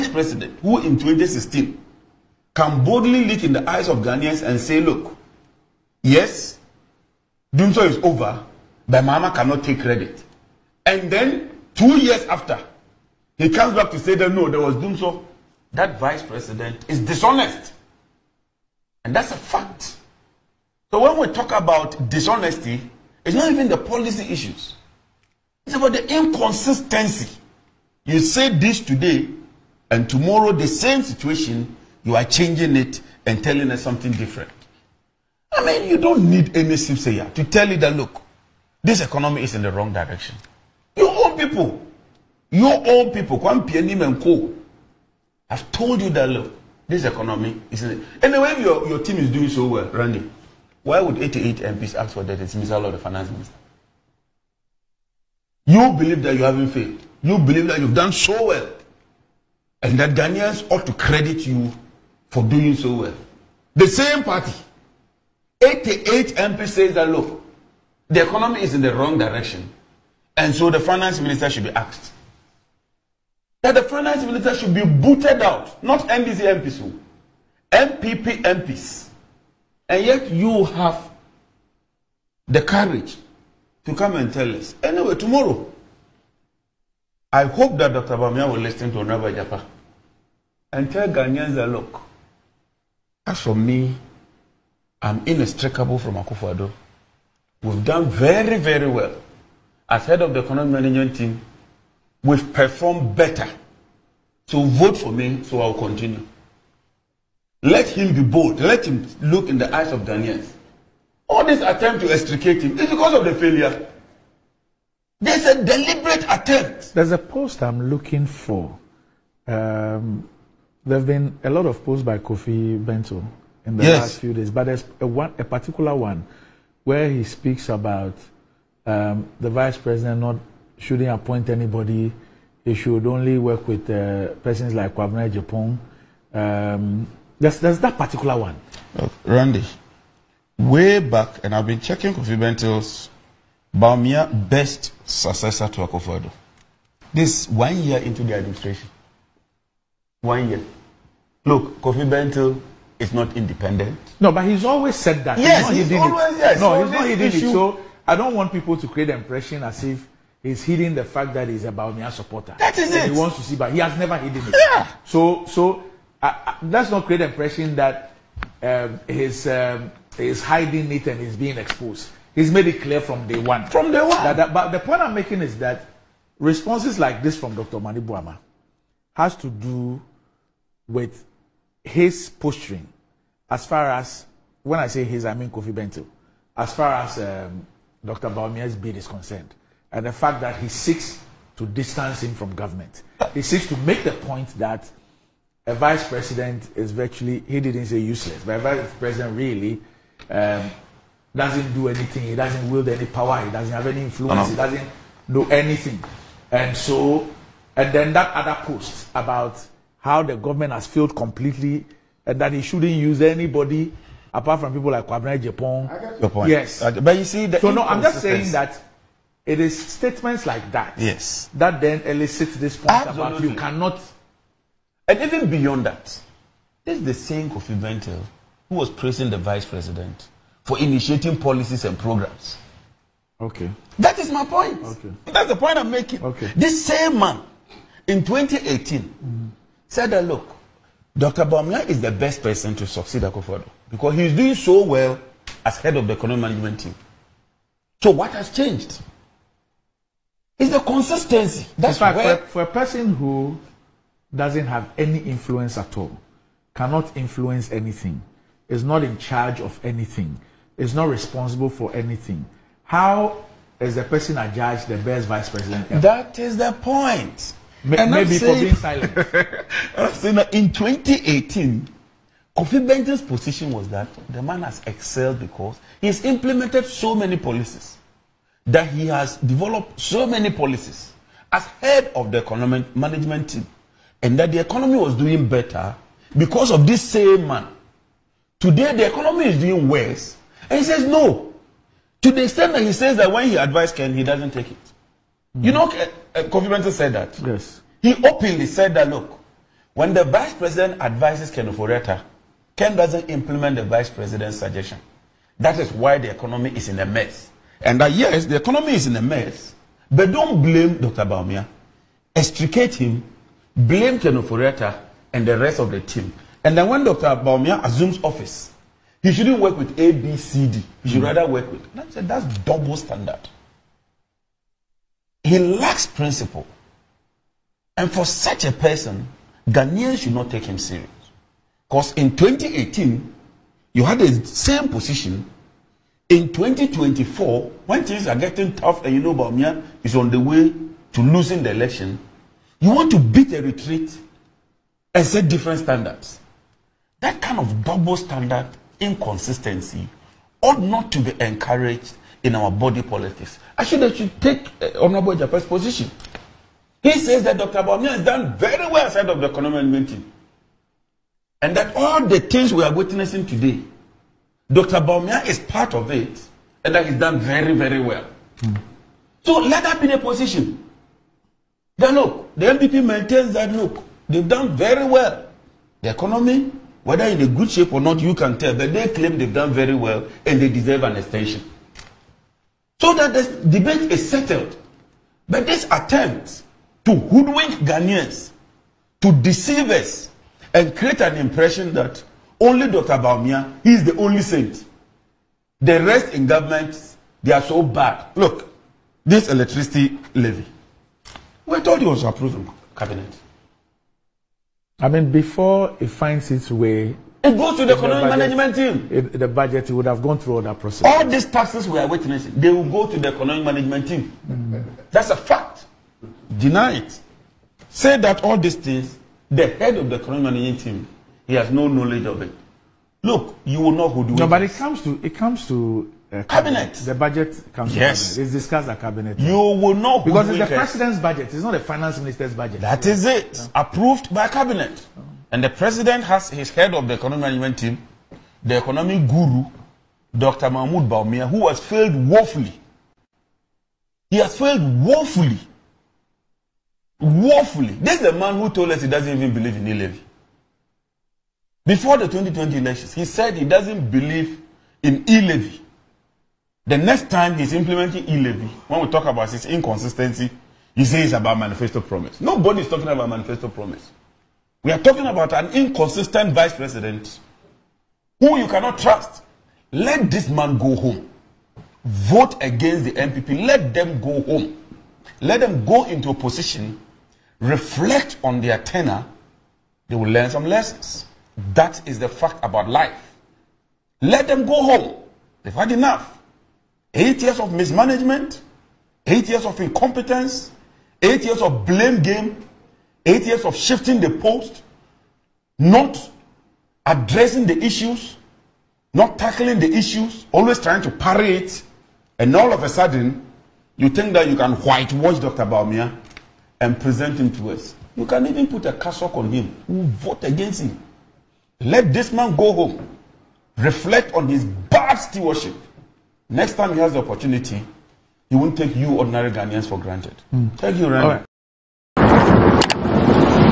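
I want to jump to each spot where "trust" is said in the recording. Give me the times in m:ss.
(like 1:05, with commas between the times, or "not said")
7:48.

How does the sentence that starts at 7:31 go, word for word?
Before the 2020 elections, he said he doesn't believe in e-levy.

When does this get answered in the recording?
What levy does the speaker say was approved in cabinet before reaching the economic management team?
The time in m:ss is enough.
6:39.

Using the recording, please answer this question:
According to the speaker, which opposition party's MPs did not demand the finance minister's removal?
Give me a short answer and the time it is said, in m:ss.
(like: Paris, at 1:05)
NDC, at 1:16.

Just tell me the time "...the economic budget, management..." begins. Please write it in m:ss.
6:47.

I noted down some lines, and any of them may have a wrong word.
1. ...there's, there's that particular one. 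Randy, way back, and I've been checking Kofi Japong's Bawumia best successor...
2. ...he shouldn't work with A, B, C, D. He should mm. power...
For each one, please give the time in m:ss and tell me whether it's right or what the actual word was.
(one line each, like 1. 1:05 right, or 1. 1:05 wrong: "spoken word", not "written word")
1. 2:17 wrong: "Bentil", not "Japong"
2. 5:19 wrong: "rather", not "power".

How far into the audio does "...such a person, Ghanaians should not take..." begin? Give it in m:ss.
5:28.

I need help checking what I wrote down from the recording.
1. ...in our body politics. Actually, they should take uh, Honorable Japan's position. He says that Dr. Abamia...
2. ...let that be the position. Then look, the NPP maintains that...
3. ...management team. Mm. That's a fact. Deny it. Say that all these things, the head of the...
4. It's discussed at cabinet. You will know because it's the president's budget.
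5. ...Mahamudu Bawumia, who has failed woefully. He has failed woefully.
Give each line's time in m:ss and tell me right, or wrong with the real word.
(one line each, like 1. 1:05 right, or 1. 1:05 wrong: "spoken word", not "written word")
1. 5:52 right
2. 6:09 right
3. 6:53 right
4. 7:08 right
5. 7:20 right.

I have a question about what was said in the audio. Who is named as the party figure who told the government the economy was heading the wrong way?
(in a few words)
Kwame Pianim.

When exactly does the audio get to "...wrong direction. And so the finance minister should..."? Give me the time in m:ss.
1:08.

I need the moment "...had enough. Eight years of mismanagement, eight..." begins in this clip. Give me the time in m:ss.
8:05.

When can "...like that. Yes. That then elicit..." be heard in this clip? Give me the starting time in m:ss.
3:40.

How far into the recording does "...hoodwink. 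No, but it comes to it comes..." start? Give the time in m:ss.
7:04.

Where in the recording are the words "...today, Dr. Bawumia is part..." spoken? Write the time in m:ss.
6:03.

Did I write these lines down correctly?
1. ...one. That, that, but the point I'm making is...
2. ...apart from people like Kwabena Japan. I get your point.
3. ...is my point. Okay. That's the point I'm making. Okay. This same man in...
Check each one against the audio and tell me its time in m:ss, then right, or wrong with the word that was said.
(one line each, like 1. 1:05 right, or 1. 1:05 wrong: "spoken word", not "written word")
1. 2:54 right
2. 3:34 right
3. 3:54 right.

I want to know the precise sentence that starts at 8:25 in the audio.
Bawumia and present him to us.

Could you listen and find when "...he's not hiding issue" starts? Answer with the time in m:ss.
2:36.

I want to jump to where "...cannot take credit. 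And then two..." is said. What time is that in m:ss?
0:09.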